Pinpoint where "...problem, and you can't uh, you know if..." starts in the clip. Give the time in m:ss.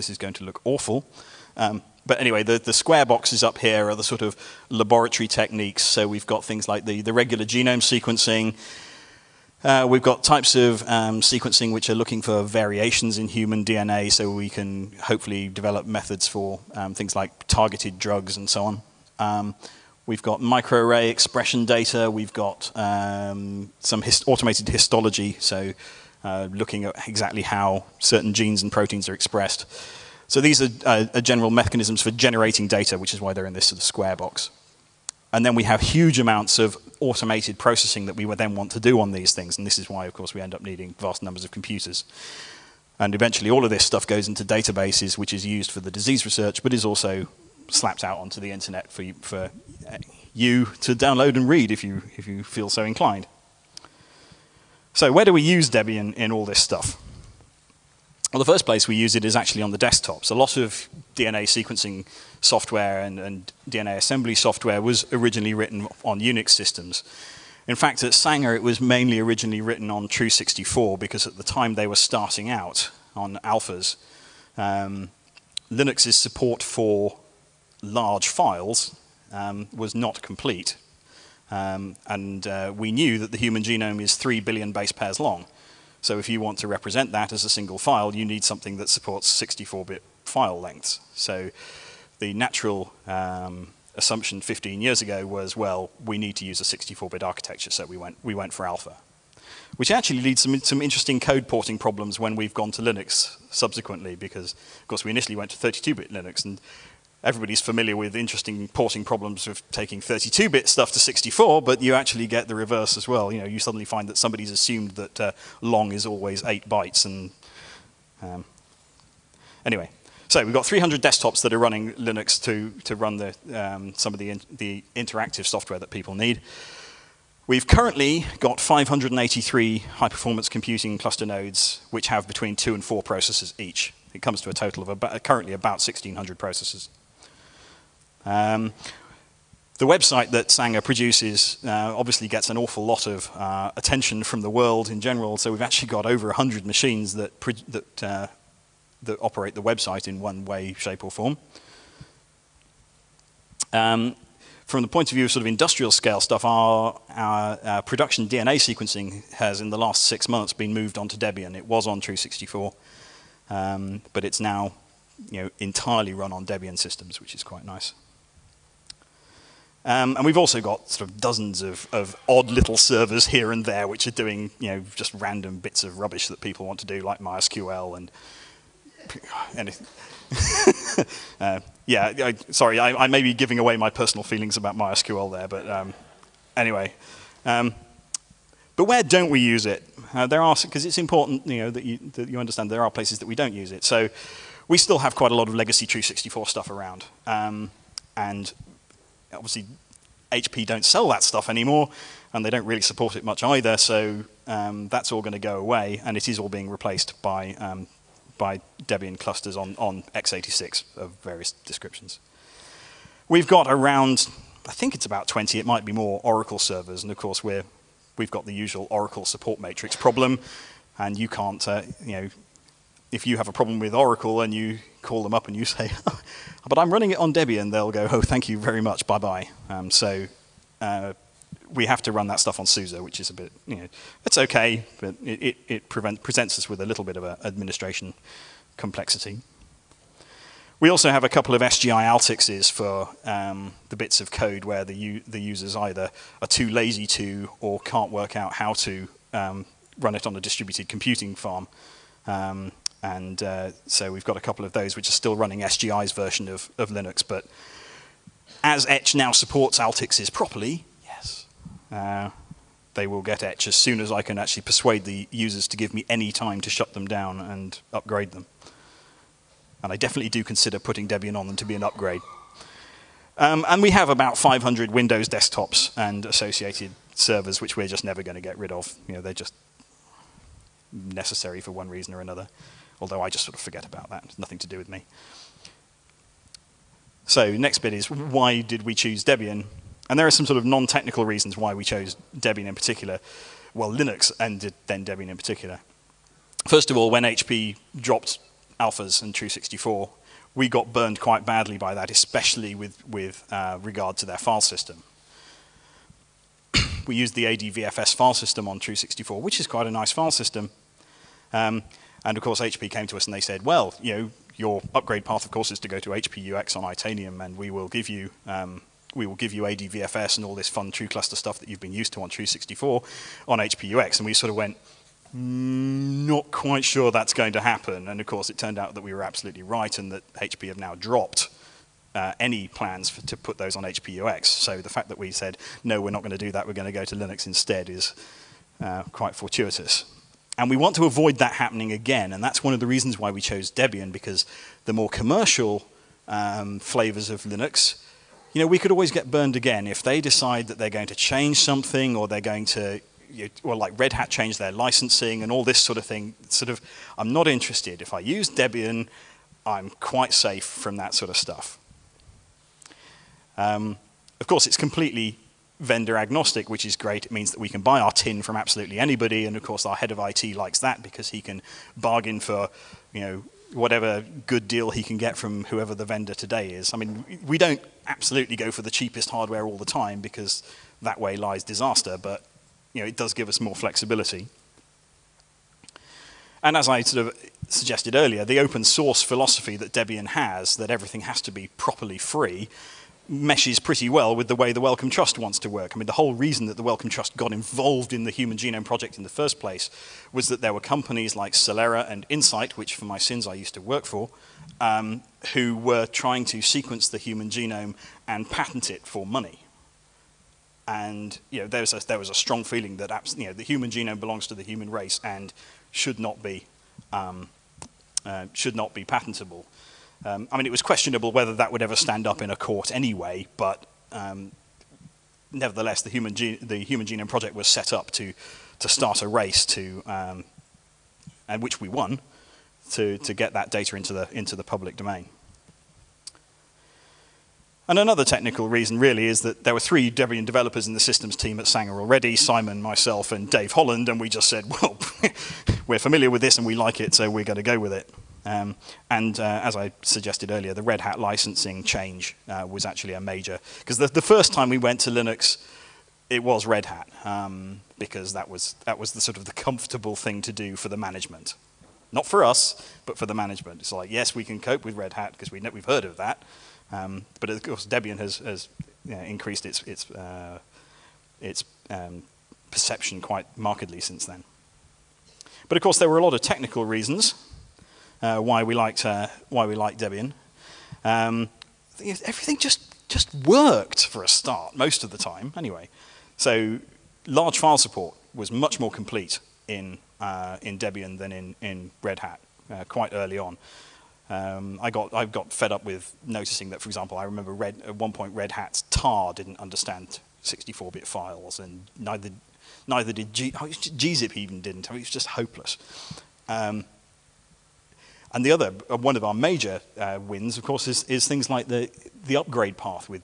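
3:39.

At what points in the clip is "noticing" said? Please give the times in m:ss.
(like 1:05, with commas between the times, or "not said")
8:16.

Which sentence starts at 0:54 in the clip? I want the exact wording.
So where do we use Debian in all this stuff?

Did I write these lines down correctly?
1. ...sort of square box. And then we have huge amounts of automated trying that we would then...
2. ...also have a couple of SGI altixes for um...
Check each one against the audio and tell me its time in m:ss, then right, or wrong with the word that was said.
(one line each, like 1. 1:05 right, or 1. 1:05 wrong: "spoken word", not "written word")
1. 0:33 wrong: "processing", not "trying"
2. 4:00 right.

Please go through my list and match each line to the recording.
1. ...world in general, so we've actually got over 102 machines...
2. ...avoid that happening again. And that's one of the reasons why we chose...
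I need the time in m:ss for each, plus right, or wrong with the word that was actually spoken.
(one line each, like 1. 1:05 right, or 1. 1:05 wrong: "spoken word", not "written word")
1. 2:24 wrong: "100", not "102"
2. 5:41 right.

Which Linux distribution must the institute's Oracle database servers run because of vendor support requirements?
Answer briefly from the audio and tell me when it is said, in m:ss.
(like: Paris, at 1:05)
SUSE, at 3:52.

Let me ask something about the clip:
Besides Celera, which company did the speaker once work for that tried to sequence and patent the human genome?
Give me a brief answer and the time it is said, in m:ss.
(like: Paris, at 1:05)
Incyte, at 6:42.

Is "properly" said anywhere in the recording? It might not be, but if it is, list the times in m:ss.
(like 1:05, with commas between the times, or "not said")
4:20, 6:31.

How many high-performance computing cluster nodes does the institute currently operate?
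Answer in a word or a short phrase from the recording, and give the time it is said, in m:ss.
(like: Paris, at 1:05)
583, at 2:08.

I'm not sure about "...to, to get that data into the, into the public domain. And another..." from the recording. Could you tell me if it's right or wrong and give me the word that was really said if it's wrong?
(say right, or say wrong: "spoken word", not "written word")
right.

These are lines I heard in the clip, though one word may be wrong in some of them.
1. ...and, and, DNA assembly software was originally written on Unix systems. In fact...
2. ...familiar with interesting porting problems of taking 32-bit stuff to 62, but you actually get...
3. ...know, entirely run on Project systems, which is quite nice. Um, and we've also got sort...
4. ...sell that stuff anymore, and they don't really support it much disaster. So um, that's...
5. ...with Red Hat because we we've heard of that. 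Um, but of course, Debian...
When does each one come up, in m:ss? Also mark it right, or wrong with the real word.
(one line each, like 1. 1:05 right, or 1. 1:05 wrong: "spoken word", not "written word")
1. 1:02 right
2. 1:47 wrong: "64", not "62"
3. 2:45 wrong: "Debian", not "Project"
4. 3:20 wrong: "either", not "disaster"
5. 7:44 right.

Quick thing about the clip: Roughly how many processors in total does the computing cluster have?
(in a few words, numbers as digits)
1,600.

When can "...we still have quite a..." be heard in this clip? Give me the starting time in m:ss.
3:14.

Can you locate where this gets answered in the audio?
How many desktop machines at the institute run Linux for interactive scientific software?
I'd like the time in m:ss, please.
2:00.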